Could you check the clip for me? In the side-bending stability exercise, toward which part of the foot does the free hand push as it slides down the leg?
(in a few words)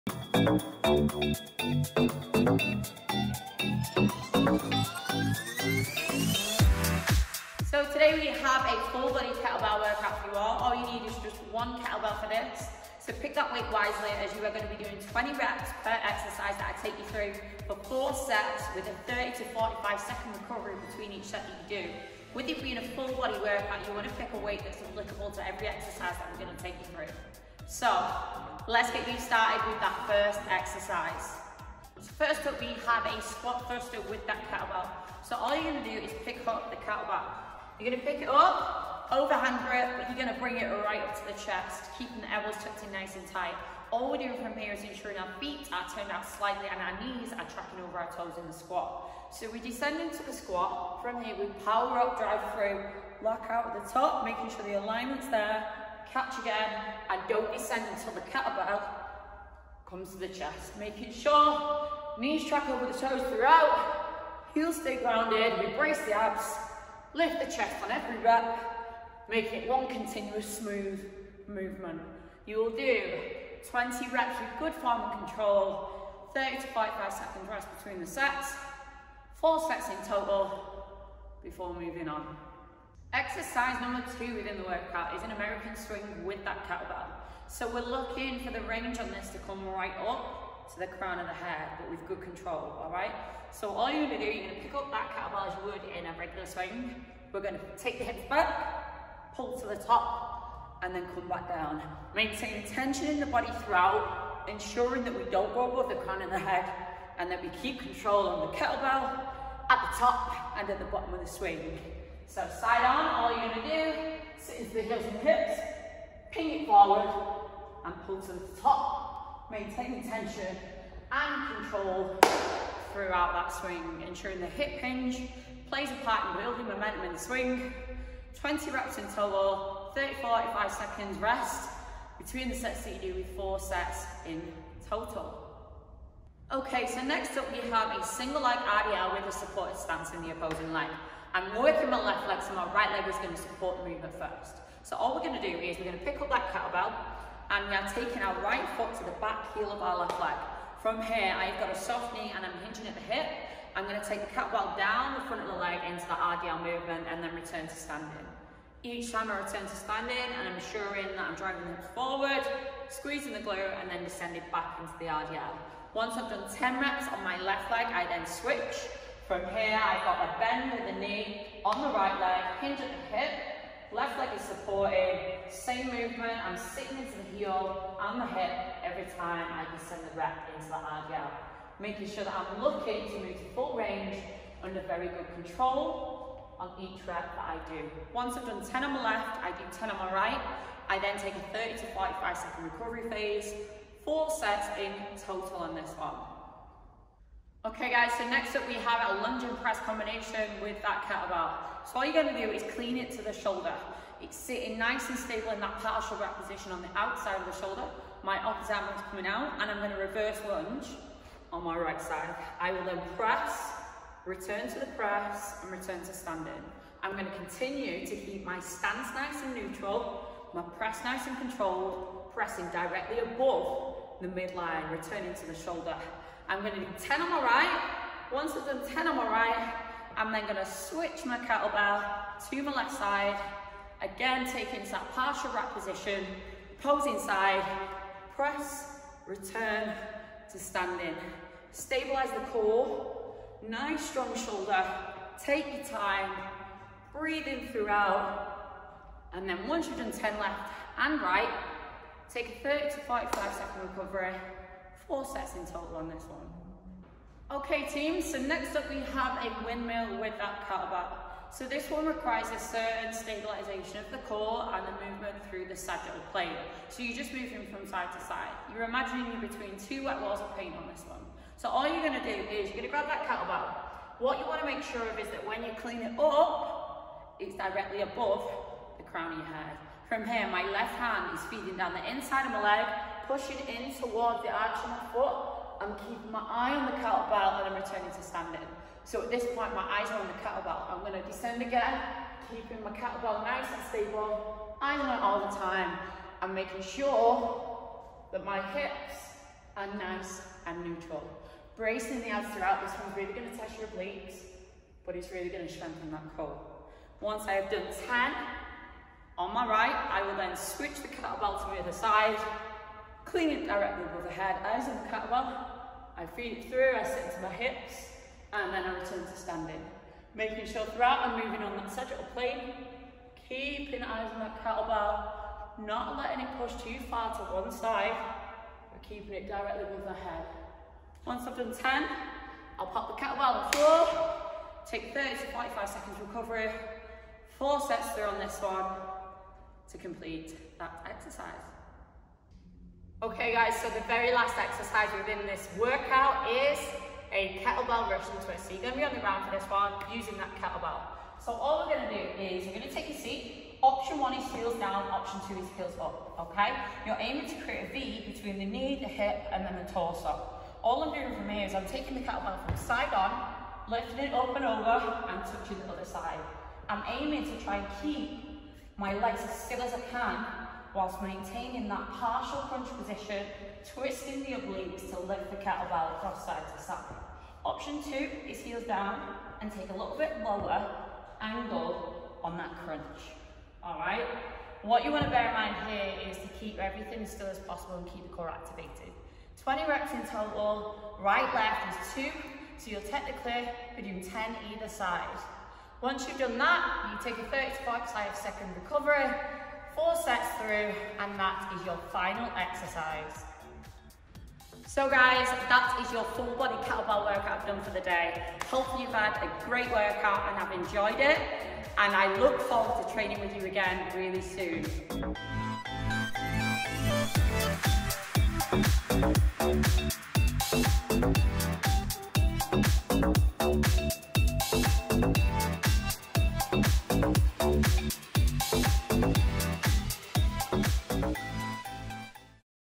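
arch.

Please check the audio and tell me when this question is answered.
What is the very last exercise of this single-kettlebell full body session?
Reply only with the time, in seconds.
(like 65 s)
347 s.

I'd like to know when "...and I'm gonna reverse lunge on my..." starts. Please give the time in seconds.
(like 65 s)
209 s.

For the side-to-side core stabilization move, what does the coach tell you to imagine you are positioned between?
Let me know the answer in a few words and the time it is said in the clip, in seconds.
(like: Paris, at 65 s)
two wet walls of paint, at 269 s.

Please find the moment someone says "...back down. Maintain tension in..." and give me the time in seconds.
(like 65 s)
101 s.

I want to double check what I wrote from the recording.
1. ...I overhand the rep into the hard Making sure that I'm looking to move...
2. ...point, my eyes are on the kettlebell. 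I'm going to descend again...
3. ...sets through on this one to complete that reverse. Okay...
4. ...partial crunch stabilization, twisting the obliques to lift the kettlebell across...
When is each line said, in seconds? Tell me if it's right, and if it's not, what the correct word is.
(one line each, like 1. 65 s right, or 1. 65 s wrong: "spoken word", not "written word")
1. 179 s wrong: "descend", not "overhand"
2. 289 s right
3. 337 s wrong: "exercise", not "reverse"
4. 372 s wrong: "position", not "stabilization".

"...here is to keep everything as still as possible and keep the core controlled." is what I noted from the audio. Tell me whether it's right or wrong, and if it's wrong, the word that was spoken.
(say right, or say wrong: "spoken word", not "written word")
wrong: "activated", not "controlled".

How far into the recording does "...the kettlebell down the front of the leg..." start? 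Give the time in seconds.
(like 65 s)
154 s.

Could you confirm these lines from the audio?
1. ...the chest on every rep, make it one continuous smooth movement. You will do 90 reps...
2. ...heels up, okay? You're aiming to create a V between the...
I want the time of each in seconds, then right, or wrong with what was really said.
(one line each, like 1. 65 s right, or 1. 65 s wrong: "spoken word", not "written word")
1. 67 s wrong: "20", not "90"
2. 355 s right.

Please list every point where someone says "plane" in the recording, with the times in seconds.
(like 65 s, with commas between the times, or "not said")
266 s, 322 s.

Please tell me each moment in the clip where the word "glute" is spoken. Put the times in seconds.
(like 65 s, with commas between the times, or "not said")
163 s.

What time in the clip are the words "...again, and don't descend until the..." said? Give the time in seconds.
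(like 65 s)
56 s.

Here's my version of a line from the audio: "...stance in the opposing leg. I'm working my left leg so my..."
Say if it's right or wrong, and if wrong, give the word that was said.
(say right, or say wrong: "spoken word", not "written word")
right.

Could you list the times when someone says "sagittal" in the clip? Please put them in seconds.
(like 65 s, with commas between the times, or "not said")
265 s, 321 s.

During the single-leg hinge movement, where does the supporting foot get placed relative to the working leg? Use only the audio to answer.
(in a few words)
back heel.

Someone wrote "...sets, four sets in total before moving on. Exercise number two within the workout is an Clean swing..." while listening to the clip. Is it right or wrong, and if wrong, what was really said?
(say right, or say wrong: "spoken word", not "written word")
wrong: "American", not "Clean".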